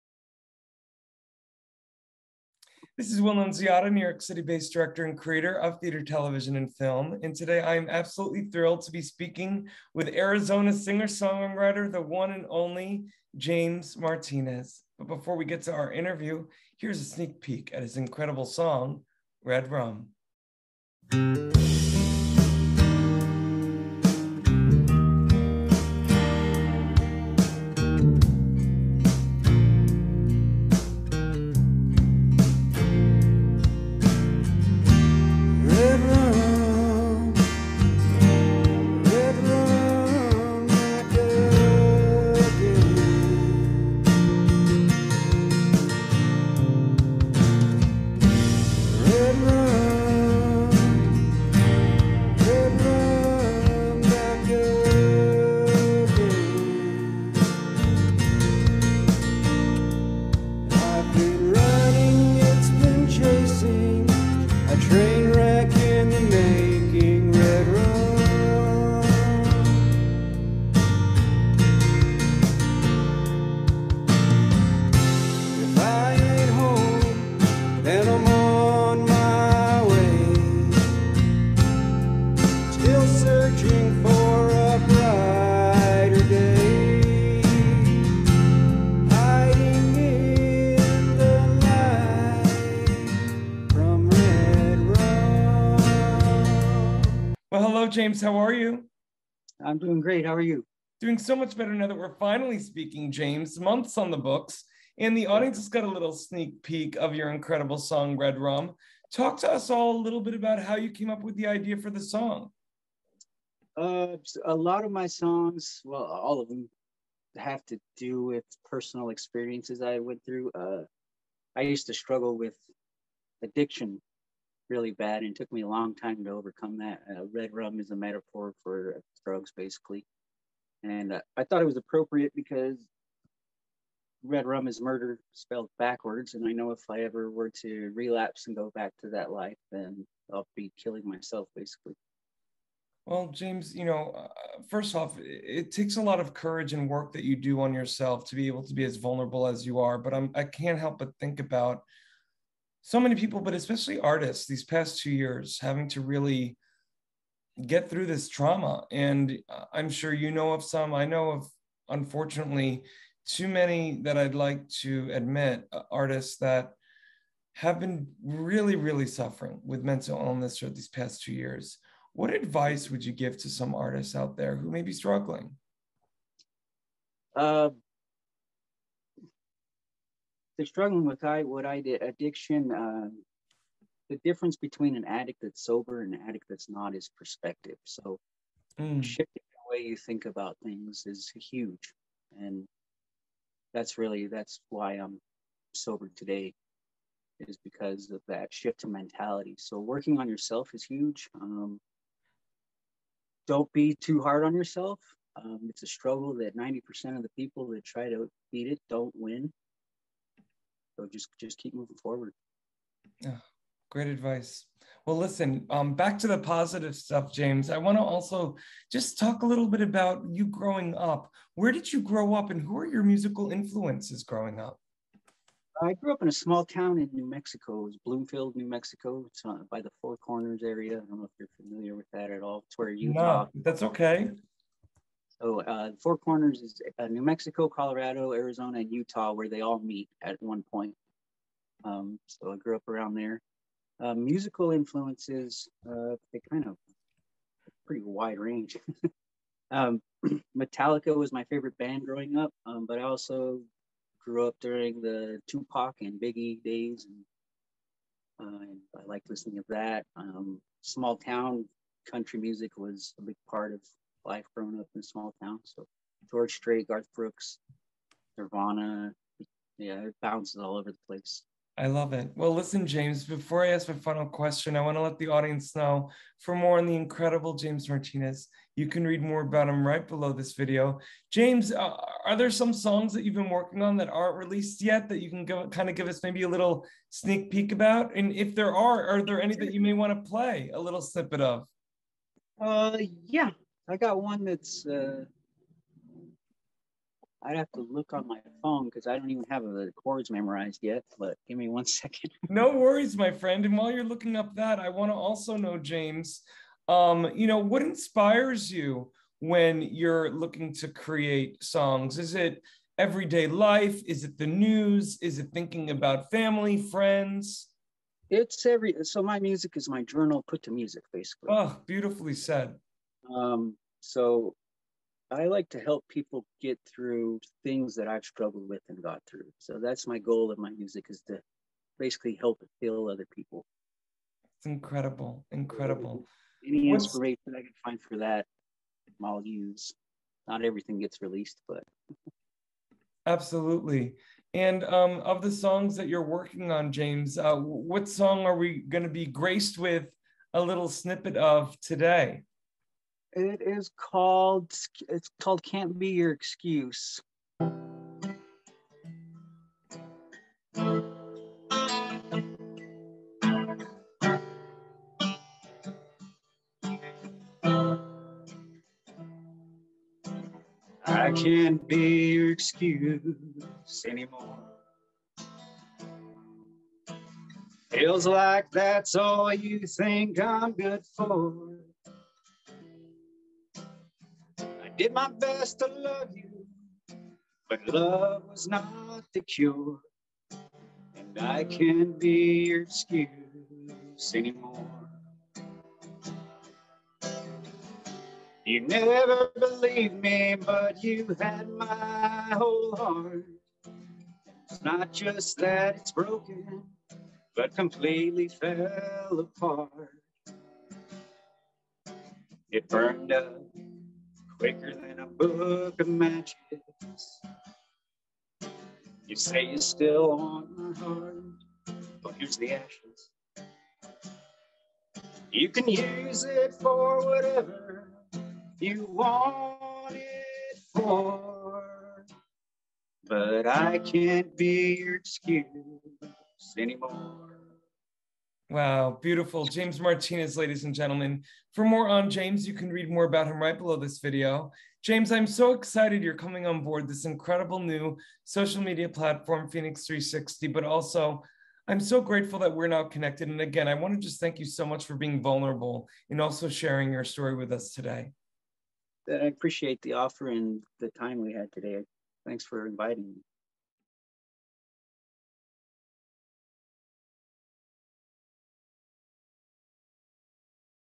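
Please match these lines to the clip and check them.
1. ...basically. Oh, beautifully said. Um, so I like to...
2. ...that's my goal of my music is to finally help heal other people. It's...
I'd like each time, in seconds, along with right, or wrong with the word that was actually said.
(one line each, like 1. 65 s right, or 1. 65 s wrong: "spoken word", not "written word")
1. 321 s right
2. 329 s wrong: "basically", not "finally".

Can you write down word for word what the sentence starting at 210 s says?
So just just keep moving forward.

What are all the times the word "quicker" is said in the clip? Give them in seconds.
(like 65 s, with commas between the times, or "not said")
414 s.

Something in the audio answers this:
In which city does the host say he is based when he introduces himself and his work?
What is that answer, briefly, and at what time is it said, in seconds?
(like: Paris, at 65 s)
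New York City, at 3 s.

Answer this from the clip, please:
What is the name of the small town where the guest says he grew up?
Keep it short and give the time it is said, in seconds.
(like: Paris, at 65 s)
Bloomfield, at 228 s.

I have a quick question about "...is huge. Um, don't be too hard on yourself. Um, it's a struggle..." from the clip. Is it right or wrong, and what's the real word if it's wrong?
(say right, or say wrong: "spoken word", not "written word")
right.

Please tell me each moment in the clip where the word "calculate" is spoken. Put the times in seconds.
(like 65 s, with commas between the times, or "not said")
not said.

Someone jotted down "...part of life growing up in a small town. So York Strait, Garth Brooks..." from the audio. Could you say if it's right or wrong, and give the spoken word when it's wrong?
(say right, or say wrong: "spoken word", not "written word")
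wrong: "George", not "York".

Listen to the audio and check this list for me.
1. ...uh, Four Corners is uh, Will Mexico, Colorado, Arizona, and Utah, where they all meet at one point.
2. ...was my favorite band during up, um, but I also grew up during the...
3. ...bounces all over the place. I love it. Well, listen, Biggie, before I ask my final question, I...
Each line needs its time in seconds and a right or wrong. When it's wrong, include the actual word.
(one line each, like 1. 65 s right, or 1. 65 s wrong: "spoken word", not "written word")
1. 235 s wrong: "New", not "Will"
2. 251 s wrong: "growing", not "during"
3. 270 s wrong: "James", not "Biggie".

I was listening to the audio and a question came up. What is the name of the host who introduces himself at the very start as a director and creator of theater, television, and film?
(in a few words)
Will Nunziata.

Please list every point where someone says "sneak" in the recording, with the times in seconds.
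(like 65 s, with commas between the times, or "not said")
17 s, 106 s, 287 s.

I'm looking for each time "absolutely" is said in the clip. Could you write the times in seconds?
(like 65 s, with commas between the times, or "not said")
7 s, 343 s.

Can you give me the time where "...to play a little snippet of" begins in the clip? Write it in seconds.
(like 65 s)
290 s.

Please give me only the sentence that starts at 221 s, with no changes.
Where did you grow up, and who are your musical influences growing up?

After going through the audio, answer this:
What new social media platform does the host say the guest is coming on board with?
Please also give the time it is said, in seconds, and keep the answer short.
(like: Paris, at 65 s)
FENIX 360, at 449 s.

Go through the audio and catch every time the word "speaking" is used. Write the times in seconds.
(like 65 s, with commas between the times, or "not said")
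9 s, 102 s.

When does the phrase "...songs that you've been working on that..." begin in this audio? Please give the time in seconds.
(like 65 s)
282 s.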